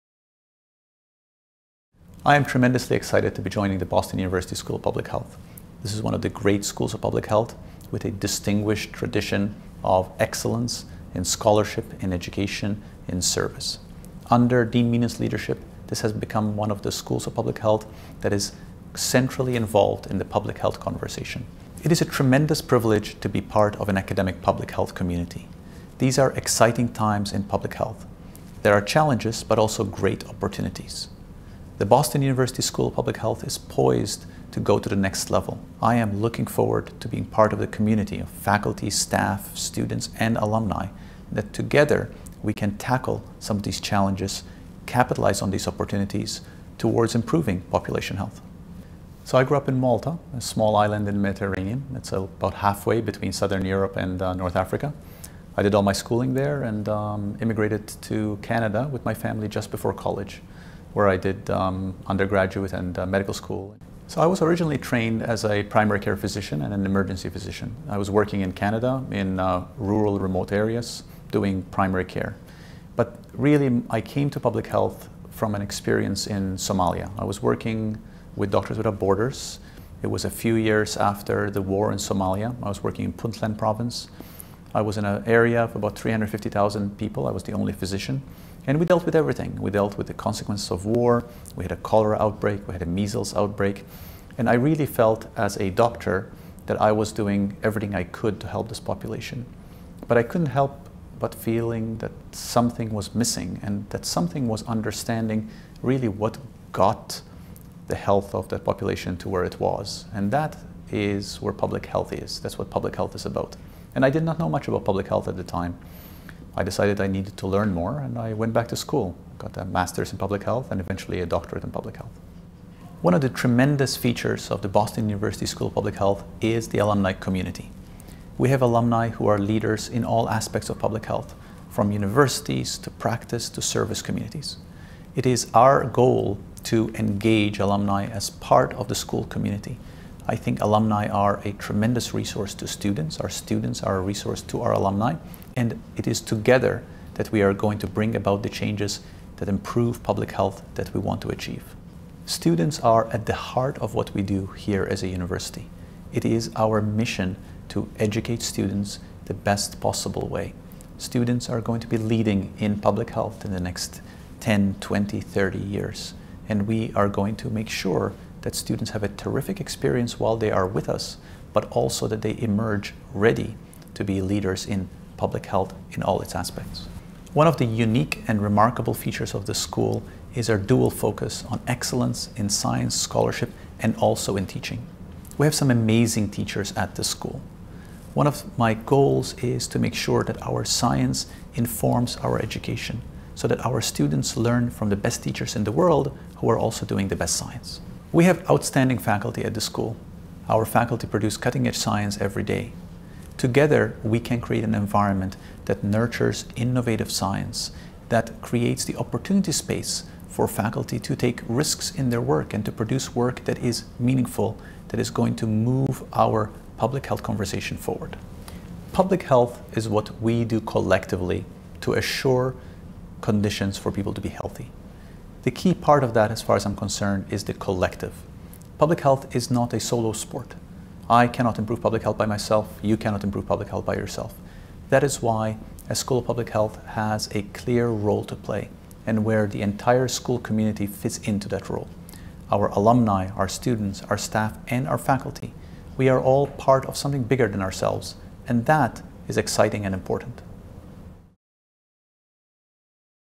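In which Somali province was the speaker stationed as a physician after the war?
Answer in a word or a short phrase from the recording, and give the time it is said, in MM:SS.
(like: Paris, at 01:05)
Puntland, at 01:23.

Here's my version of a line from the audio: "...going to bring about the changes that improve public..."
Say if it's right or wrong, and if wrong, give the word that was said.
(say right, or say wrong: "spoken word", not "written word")
right.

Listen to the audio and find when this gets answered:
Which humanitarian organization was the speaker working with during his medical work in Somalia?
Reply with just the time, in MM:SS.
01:18.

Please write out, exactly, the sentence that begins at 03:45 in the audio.
The key part of that, as far as I'm concerned, is the collective.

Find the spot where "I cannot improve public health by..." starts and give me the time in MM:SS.
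03:51.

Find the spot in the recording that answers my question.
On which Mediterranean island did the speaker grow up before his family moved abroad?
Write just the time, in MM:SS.
00:49.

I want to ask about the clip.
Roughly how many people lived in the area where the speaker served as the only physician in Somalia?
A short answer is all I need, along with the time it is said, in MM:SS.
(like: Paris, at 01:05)
350,000, at 01:25.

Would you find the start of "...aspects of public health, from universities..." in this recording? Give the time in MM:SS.
02:10.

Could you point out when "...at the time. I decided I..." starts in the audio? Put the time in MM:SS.
01:55.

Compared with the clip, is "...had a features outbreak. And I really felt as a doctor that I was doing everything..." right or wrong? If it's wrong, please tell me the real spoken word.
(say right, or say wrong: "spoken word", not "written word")
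wrong: "measles", not "features".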